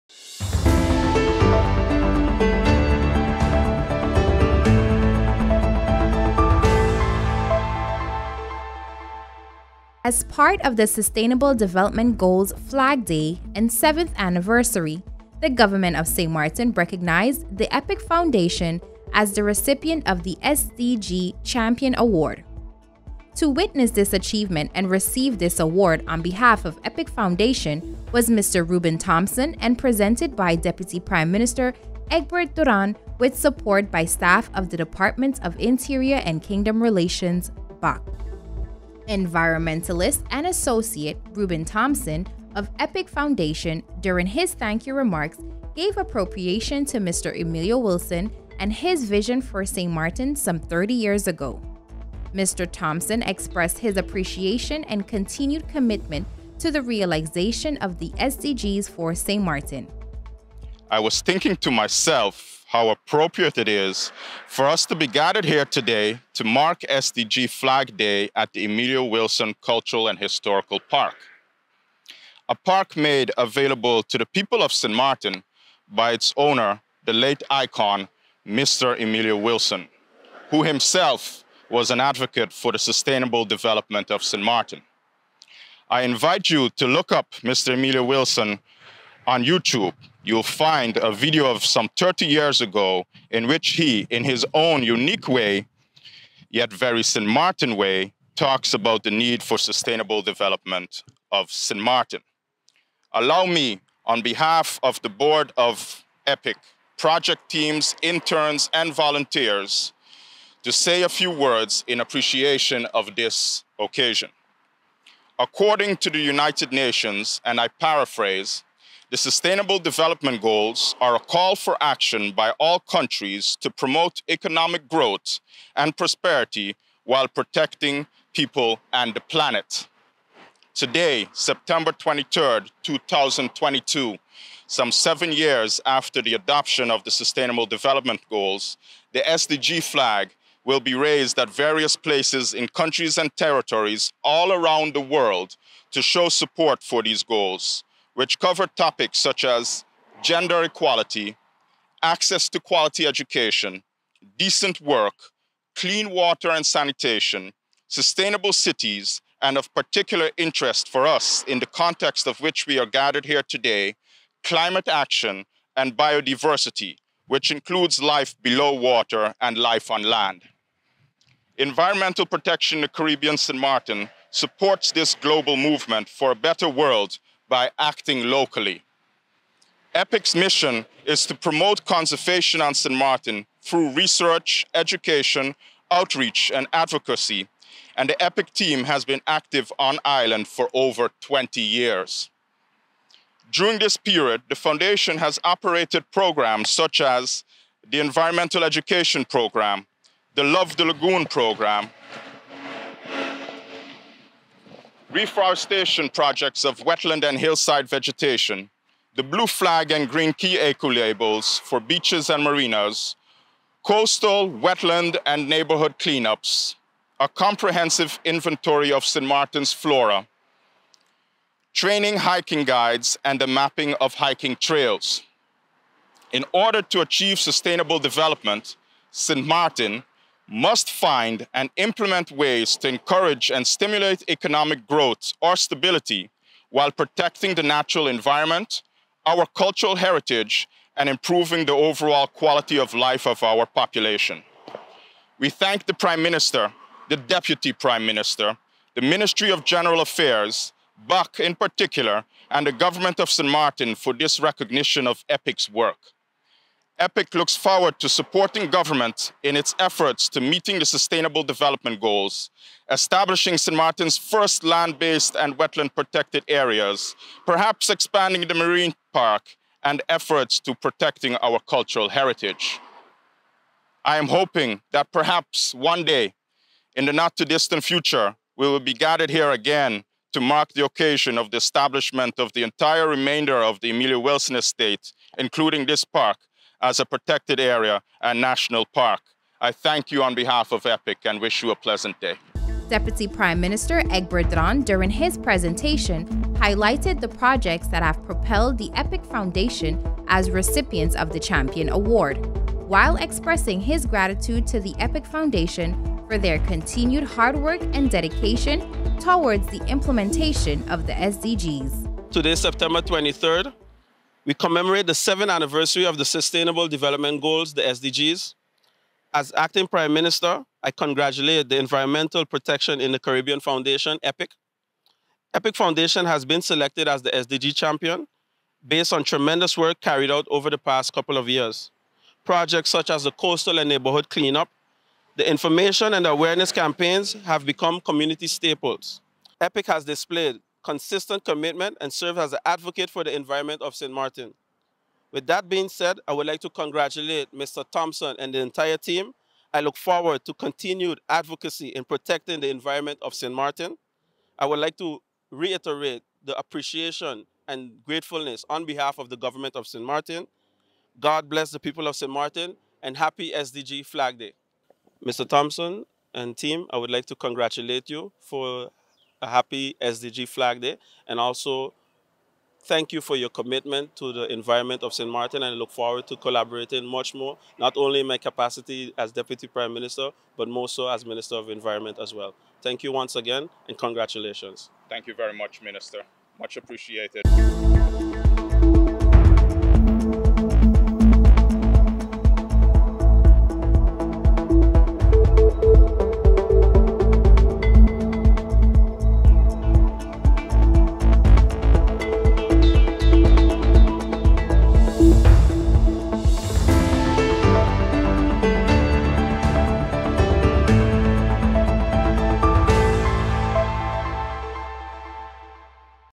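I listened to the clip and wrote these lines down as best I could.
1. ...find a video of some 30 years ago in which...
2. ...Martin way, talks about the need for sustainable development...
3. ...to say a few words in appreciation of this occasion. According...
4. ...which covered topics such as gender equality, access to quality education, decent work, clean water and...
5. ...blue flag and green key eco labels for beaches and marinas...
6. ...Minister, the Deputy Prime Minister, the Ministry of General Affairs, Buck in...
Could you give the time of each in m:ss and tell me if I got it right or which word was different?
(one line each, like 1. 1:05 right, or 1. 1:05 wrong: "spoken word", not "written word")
1. 1:30 right
2. 1:37 right
3. 1:50 right
4. 2:28 right
5. 3:29 right
6. 4:06 right.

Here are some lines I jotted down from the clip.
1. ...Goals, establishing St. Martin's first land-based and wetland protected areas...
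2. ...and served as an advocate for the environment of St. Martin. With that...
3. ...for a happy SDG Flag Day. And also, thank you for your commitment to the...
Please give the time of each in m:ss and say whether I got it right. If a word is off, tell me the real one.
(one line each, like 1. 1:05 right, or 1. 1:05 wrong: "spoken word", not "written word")
1. 4:21 right
2. 5:42 right
3. 6:08 right.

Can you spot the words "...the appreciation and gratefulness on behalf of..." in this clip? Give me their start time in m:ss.
5:56.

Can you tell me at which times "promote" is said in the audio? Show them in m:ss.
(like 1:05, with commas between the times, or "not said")
2:03, 3:01.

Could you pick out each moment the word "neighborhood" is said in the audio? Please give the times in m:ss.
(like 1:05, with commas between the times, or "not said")
3:35, 5:33.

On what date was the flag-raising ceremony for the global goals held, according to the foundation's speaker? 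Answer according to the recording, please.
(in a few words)
September 23, 2022.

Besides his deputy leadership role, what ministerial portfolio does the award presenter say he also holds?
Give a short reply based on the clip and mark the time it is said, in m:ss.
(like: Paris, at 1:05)
Minister of Environment, at 6:21.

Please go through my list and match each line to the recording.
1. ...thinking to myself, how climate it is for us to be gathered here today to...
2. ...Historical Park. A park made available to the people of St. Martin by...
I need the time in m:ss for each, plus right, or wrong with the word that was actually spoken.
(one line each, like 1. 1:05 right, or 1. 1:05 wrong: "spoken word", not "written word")
1. 1:01 wrong: "appropriate", not "climate"
2. 1:10 right.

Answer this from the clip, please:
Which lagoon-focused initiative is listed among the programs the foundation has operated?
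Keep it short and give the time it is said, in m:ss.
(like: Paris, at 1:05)
Love the Lagoon Program, at 3:20.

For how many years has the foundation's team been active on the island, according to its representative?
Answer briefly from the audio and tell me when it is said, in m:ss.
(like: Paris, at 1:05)
over 20, at 3:10.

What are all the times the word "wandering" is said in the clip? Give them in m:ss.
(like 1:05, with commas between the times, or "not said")
not said.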